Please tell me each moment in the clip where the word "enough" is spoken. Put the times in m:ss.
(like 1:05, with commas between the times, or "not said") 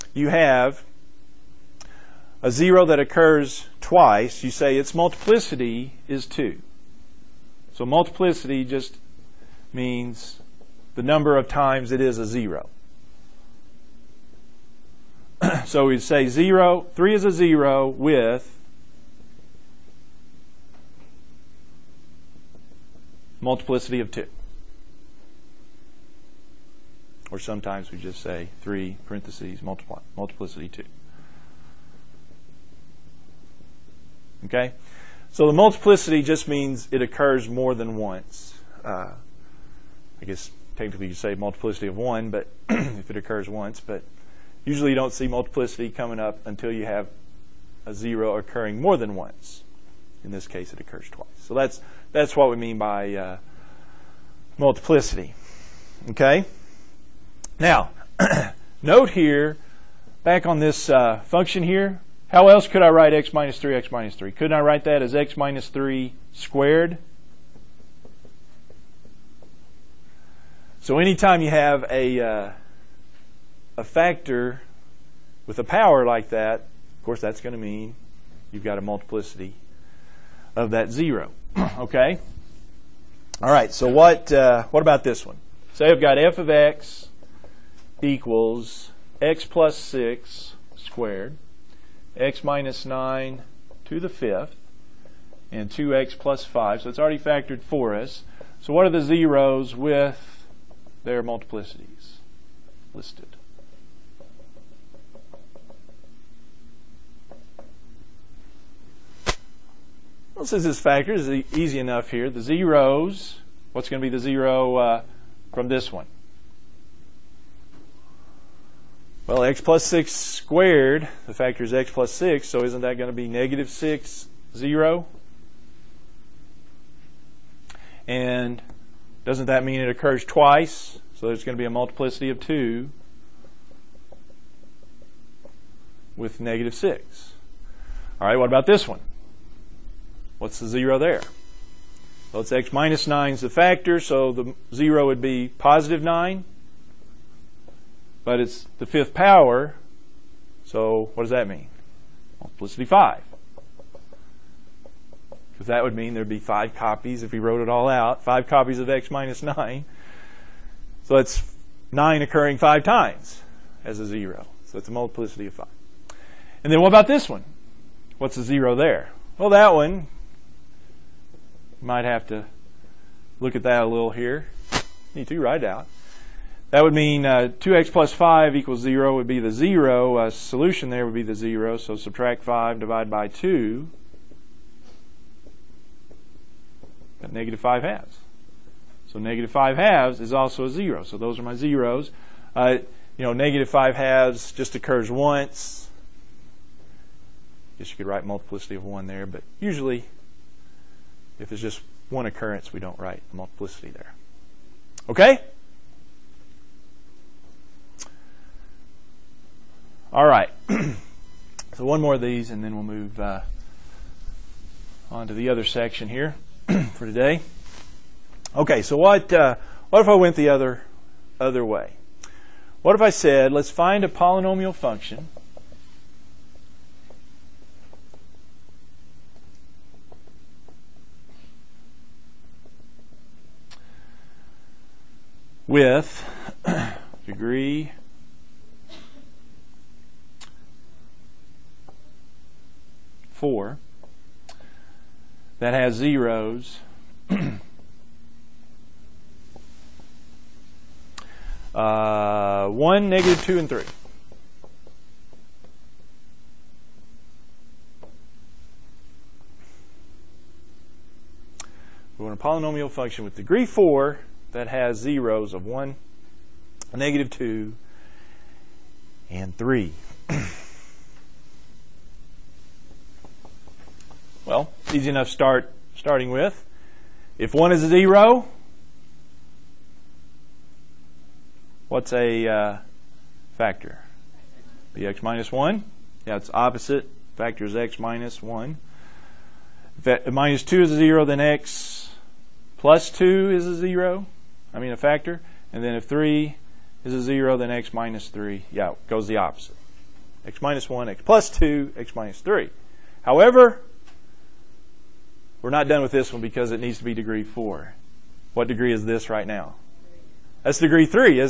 1:51, 4:35.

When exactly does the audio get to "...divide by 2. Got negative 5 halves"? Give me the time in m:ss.
3:02.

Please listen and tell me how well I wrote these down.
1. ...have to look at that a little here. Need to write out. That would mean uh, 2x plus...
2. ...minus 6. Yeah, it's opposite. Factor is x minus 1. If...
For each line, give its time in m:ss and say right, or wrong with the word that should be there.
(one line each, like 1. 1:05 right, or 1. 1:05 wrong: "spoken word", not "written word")
1. 2:52 right
2. 4:45 wrong: "1", not "6".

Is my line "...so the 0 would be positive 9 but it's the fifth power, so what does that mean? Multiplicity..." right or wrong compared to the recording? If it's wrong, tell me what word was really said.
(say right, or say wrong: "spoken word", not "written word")
right.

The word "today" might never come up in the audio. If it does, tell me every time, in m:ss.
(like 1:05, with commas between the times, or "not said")
3:37.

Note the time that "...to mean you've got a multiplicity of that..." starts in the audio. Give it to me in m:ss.
1:17.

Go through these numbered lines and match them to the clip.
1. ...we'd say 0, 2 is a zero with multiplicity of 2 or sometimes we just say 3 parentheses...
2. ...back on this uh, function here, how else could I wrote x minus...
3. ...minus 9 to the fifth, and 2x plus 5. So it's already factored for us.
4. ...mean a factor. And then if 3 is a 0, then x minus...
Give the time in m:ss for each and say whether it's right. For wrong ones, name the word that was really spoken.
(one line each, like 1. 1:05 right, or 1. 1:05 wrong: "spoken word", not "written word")
1. 0:15 wrong: "3", not "2"
2. 1:00 wrong: "write", not "wrote"
3. 1:32 right
4. 4:54 right.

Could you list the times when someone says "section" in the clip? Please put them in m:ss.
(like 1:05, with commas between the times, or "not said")
3:35.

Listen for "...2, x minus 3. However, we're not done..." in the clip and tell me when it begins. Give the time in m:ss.
5:01.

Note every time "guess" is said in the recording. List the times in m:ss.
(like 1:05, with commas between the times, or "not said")
0:40, 3:17.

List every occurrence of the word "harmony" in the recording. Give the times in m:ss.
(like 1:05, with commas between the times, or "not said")
not said.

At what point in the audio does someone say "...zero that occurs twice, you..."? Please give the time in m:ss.
0:02.